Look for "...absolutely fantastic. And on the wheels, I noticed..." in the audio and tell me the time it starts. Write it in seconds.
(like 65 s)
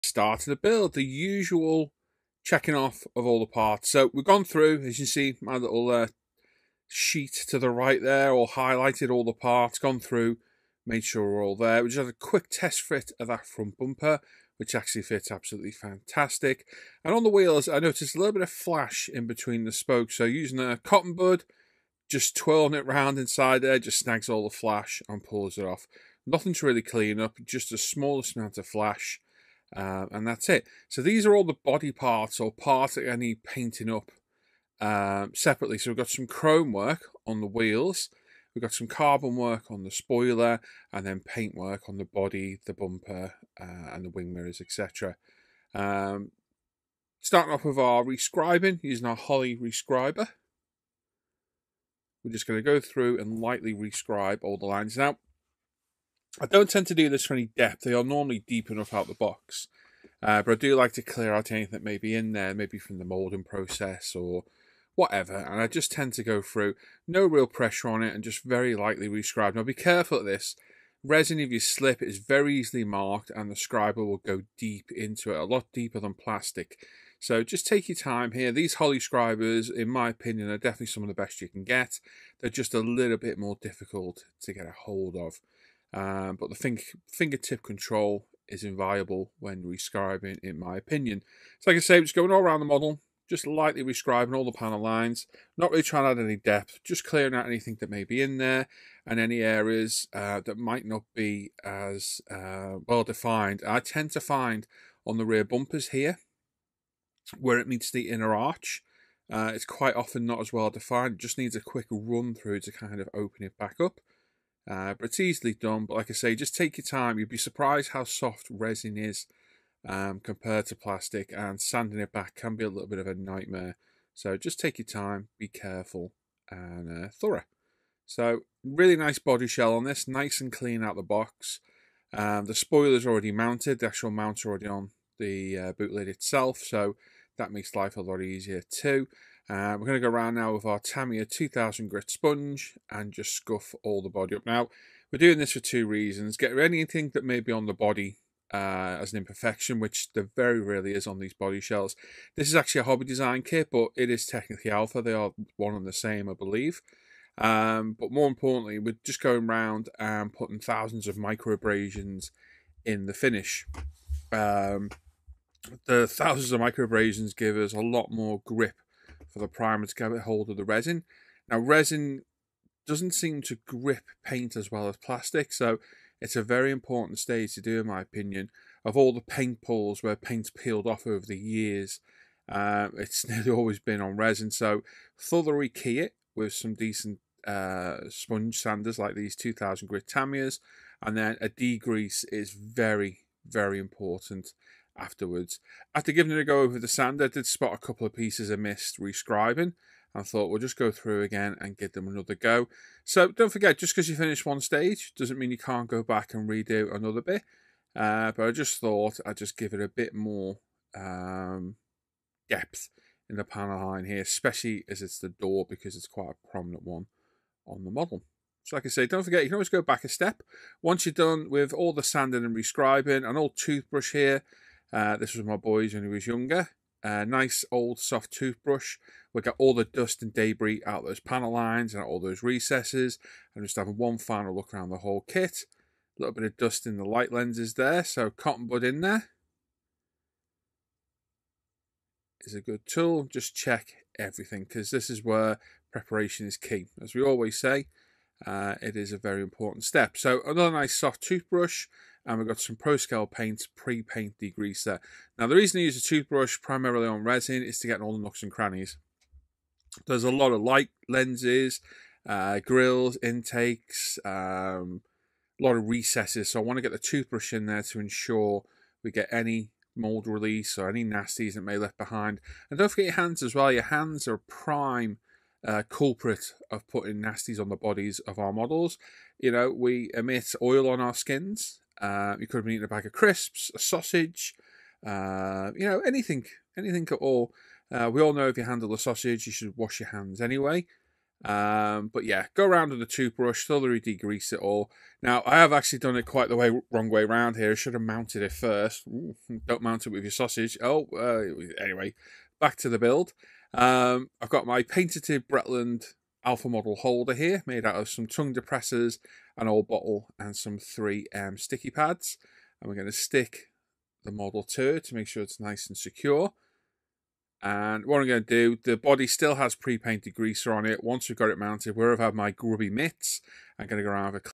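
15 s.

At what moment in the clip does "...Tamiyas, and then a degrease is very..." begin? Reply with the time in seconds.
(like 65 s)
190 s.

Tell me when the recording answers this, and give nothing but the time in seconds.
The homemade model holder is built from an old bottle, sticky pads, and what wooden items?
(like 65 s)
308 s.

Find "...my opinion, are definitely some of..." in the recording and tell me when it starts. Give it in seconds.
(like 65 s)
79 s.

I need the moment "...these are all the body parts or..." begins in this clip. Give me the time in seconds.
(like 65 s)
31 s.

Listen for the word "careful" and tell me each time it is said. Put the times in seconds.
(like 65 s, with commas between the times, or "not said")
69 s, 125 s.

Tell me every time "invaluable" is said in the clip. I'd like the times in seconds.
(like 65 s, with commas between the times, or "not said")
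88 s.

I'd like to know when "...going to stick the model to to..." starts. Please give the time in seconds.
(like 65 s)
312 s.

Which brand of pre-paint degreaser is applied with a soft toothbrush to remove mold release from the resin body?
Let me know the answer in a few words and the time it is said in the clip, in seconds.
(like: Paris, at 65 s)
ProScale, at 252 s.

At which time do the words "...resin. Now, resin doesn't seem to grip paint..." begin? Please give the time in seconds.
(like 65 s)
170 s.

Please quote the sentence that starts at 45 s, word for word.
Um, starting off with our rescribing using our Holly rescriber.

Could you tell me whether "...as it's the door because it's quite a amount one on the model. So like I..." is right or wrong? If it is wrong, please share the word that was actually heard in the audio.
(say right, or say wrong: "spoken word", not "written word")
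wrong: "prominent", not "amount".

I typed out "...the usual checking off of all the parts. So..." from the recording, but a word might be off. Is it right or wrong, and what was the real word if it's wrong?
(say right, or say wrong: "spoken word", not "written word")
right.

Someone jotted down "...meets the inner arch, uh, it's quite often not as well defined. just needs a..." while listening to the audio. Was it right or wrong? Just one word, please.
right.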